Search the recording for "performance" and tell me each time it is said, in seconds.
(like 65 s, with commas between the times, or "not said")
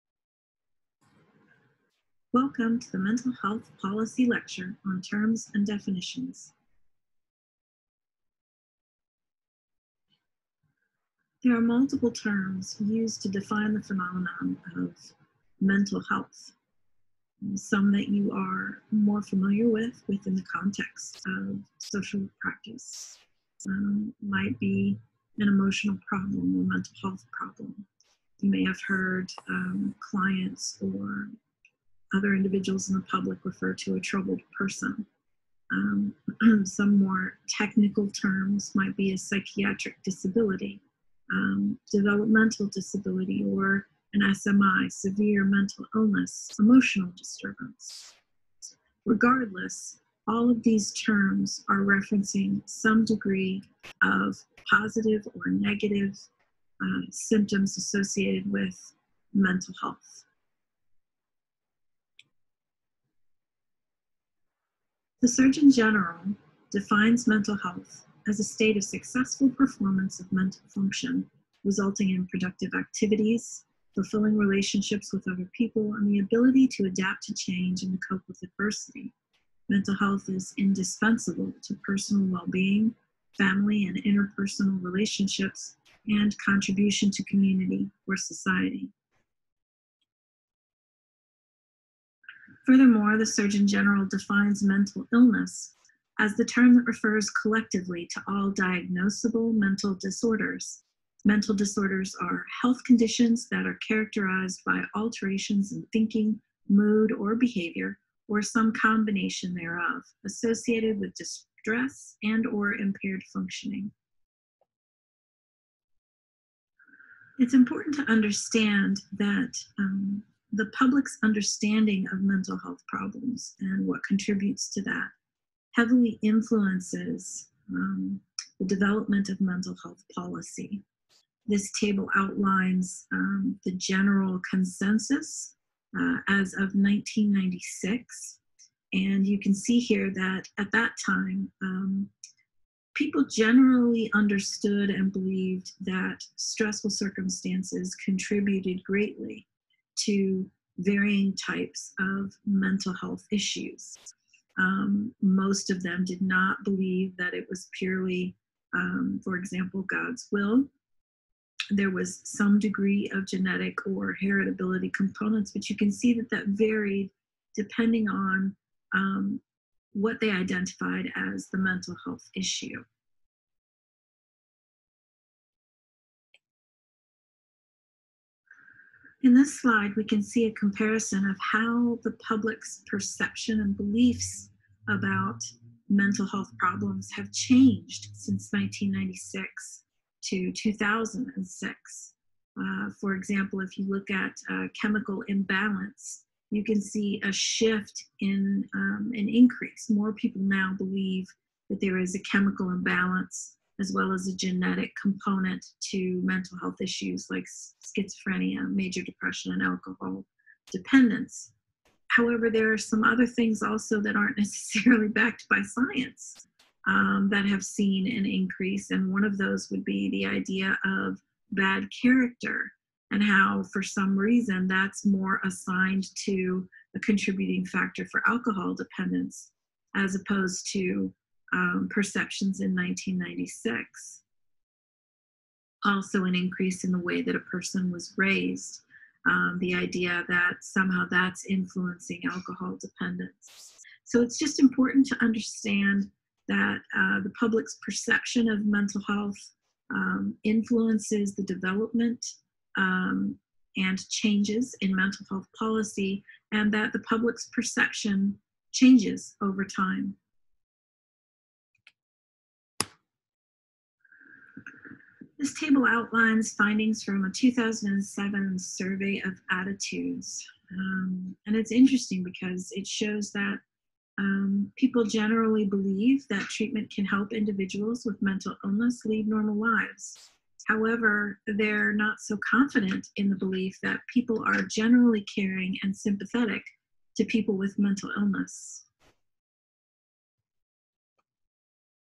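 69 s.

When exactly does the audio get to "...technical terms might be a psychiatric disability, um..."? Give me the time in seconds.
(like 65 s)
37 s.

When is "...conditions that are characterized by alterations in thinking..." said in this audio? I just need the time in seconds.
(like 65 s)
102 s.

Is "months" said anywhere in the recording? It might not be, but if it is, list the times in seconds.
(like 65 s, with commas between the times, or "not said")
not said.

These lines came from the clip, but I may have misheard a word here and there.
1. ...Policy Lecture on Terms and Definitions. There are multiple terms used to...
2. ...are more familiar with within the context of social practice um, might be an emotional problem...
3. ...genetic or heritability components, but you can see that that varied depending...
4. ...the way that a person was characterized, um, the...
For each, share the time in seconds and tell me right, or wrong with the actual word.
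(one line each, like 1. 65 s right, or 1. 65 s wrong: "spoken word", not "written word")
1. 3 s right
2. 18 s right
3. 163 s right
4. 236 s wrong: "raised", not "characterized".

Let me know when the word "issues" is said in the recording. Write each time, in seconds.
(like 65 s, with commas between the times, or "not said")
153 s, 172 s, 206 s.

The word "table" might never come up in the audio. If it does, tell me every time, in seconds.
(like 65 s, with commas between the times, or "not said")
131 s, 265 s.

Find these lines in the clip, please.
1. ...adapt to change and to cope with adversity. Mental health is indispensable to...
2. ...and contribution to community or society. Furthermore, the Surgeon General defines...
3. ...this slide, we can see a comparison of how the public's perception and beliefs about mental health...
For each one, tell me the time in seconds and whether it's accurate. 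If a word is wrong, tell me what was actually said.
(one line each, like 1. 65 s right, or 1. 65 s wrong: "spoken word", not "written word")
1. 76 s right
2. 86 s right
3. 179 s right.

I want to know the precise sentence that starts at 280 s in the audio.
However, they're not so confident in the belief that people are generally caring and sympathetic to people with mental illness.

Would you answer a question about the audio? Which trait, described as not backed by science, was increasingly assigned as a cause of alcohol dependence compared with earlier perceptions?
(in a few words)
bad character.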